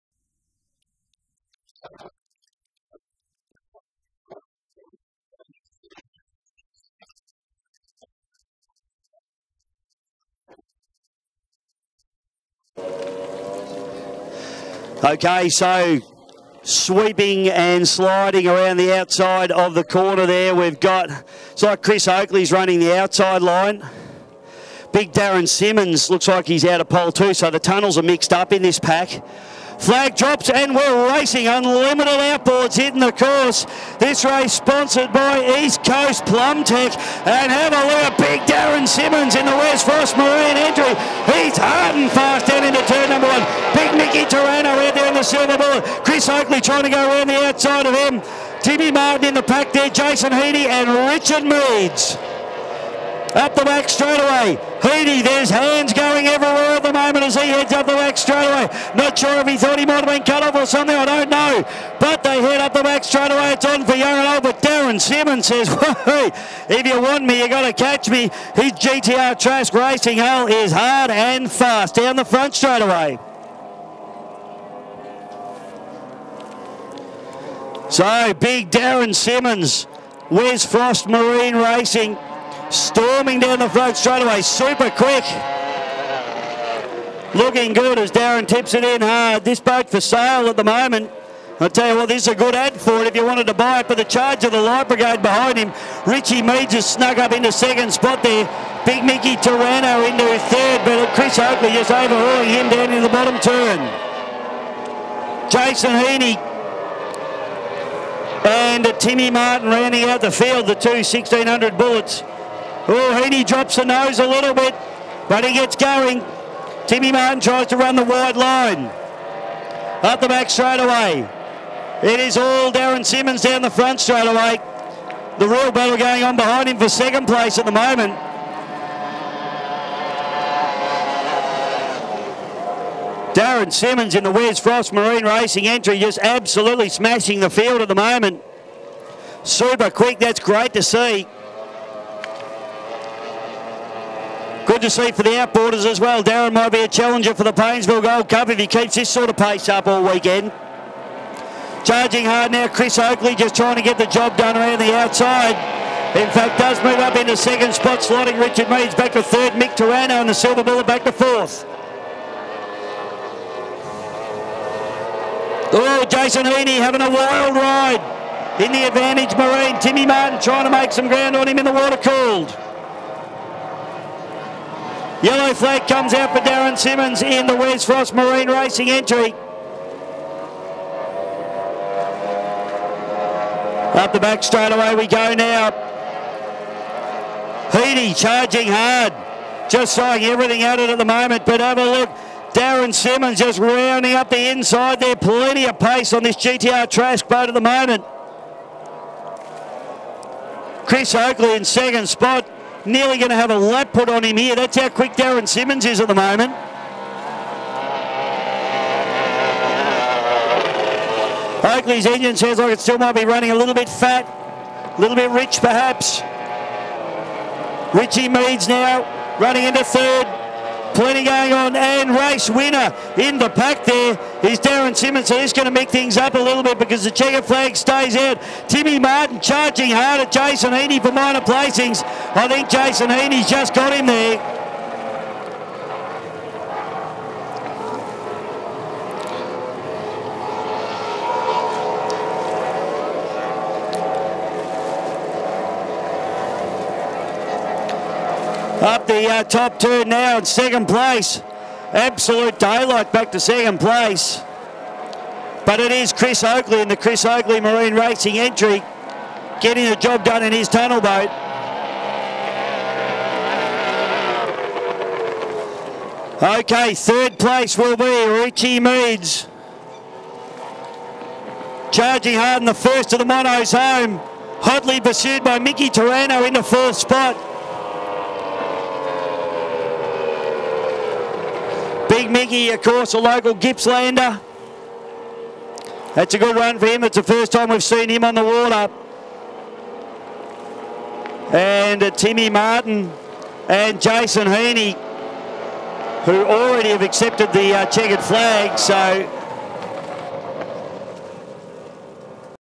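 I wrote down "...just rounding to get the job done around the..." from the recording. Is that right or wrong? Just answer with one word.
wrong.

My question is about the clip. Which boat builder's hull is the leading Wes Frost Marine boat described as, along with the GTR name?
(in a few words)
Trask Racing.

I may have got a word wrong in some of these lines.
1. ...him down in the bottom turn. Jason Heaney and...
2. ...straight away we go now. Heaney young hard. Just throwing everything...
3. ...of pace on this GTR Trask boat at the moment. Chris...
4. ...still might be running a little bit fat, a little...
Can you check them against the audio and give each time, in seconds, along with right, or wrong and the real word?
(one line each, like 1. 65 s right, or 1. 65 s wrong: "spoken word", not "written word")
1. 102 s right
2. 184 s wrong: "charging", not "young"
3. 195 s right
4. 212 s right.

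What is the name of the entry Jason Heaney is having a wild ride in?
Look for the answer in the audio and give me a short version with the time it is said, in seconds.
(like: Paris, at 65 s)
Advantage Marine, at 168 s.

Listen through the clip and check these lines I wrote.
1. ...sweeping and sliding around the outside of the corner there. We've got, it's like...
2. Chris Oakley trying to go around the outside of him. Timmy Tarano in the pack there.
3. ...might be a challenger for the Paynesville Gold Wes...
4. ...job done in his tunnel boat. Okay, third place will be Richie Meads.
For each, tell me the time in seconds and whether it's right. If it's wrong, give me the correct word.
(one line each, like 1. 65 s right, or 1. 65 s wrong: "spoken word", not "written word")
1. 16 s right
2. 46 s wrong: "Martin", not "Tarano"
3. 146 s wrong: "Cup", not "Wes"
4. 259 s right.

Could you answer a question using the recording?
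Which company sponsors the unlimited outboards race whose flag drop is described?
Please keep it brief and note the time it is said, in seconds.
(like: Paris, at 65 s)
East Coast Plum Tech, at 35 s.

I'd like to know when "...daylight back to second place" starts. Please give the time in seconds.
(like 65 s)
252 s.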